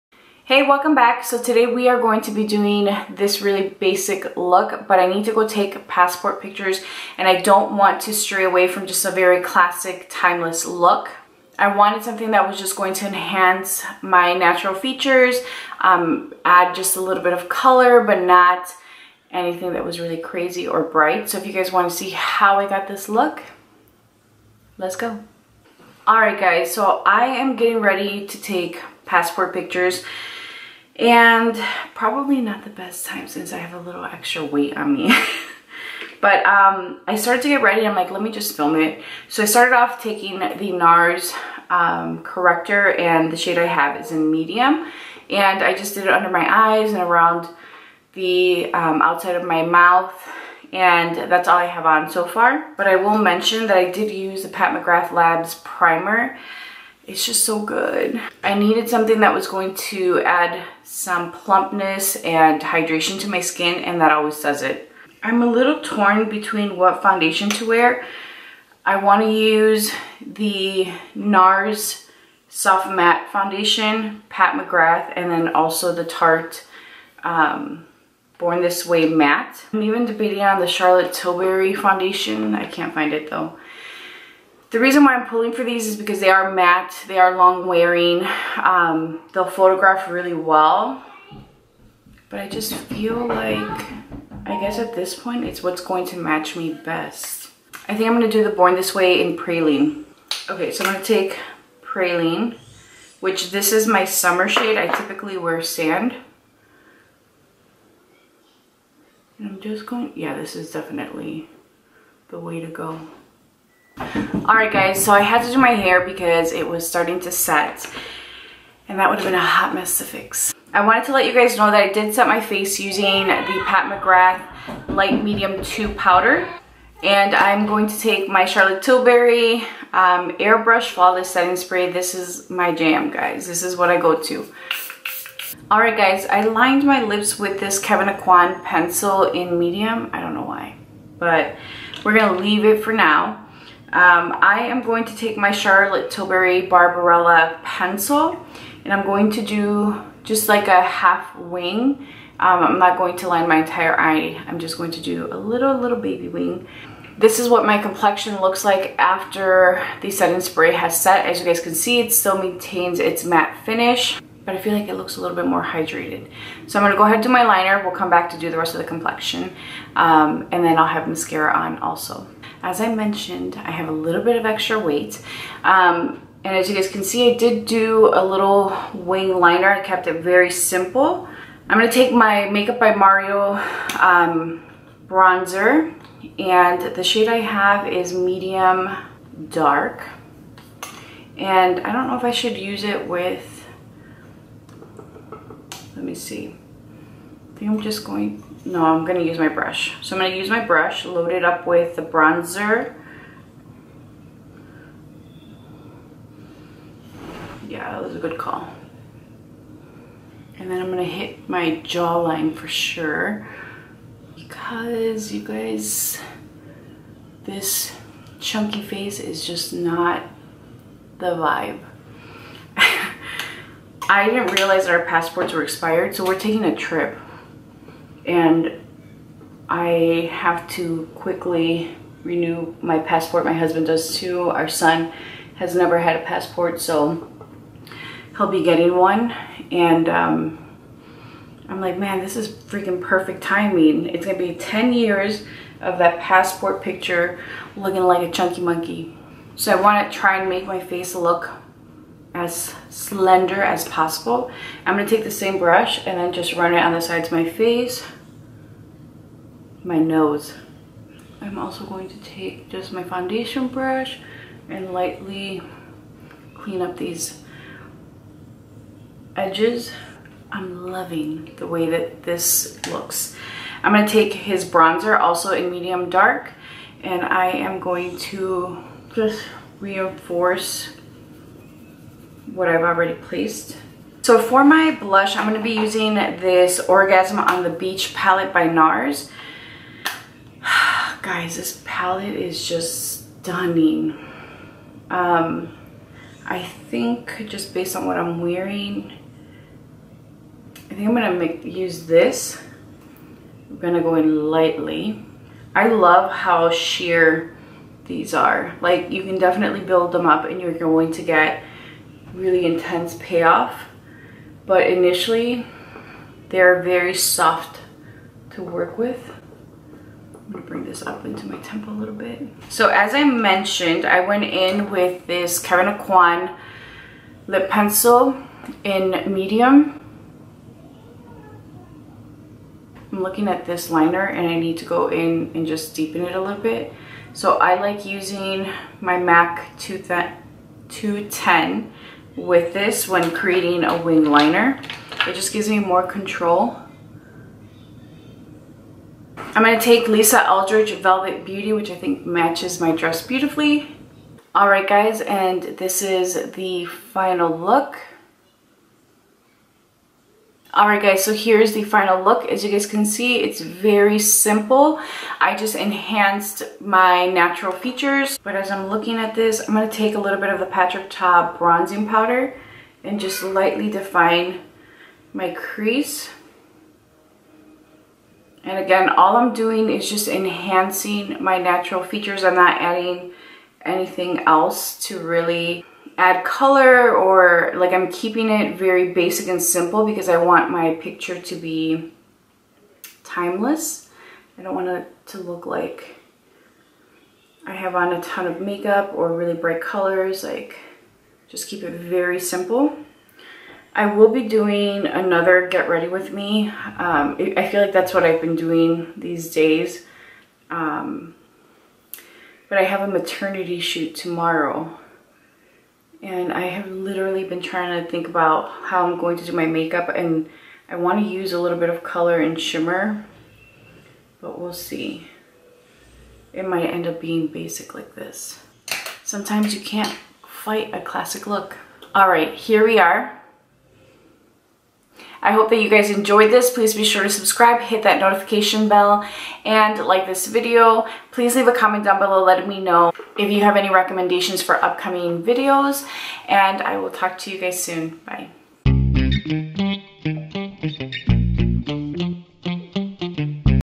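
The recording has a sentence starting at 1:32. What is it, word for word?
But I just feel like, I guess at this point, it's what's going to match me best.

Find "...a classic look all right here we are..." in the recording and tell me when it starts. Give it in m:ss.
7:10.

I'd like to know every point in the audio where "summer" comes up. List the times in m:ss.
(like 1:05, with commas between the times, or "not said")
1:44.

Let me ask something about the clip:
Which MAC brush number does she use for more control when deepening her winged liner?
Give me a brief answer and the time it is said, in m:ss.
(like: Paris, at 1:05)
210, at 5:39.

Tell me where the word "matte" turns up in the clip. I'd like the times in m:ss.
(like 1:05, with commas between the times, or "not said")
1:12, 1:19, 1:26, 2:43.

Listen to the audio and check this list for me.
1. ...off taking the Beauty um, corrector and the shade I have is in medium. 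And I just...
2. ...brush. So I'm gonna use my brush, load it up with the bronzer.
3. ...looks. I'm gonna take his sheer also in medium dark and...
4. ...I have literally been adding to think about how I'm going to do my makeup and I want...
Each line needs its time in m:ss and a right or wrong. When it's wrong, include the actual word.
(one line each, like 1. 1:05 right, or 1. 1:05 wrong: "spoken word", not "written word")
1. 0:39 wrong: "NARS", not "Beauty"
2. 3:19 right
3. 4:32 wrong: "bronzer", not "sheer"
4. 6:56 wrong: "trying", not "adding".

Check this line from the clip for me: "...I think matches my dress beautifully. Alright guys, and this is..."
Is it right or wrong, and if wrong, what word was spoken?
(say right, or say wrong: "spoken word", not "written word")
right.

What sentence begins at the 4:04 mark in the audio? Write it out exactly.
It's gonna be 10 years of that passport picture looking like a chunky monkey.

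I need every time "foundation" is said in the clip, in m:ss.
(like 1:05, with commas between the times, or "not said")
1:07, 1:13, 1:21, 4:23.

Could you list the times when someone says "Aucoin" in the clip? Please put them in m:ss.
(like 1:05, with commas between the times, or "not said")
2:18, 5:25.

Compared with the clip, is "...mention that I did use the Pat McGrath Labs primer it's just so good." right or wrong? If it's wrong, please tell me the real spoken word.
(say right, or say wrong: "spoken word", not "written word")
right.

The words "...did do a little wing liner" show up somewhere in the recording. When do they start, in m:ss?
2:57.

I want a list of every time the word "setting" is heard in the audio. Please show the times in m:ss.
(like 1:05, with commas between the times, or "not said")
2:11, 2:40.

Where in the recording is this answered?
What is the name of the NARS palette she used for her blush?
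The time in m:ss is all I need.
4:46.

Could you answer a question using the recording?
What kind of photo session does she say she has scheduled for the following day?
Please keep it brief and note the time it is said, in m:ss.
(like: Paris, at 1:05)
Maternity shoot, at 6:53.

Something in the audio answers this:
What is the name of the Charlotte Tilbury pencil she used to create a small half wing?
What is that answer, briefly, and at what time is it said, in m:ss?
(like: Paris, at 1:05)
Barbarella, at 2:26.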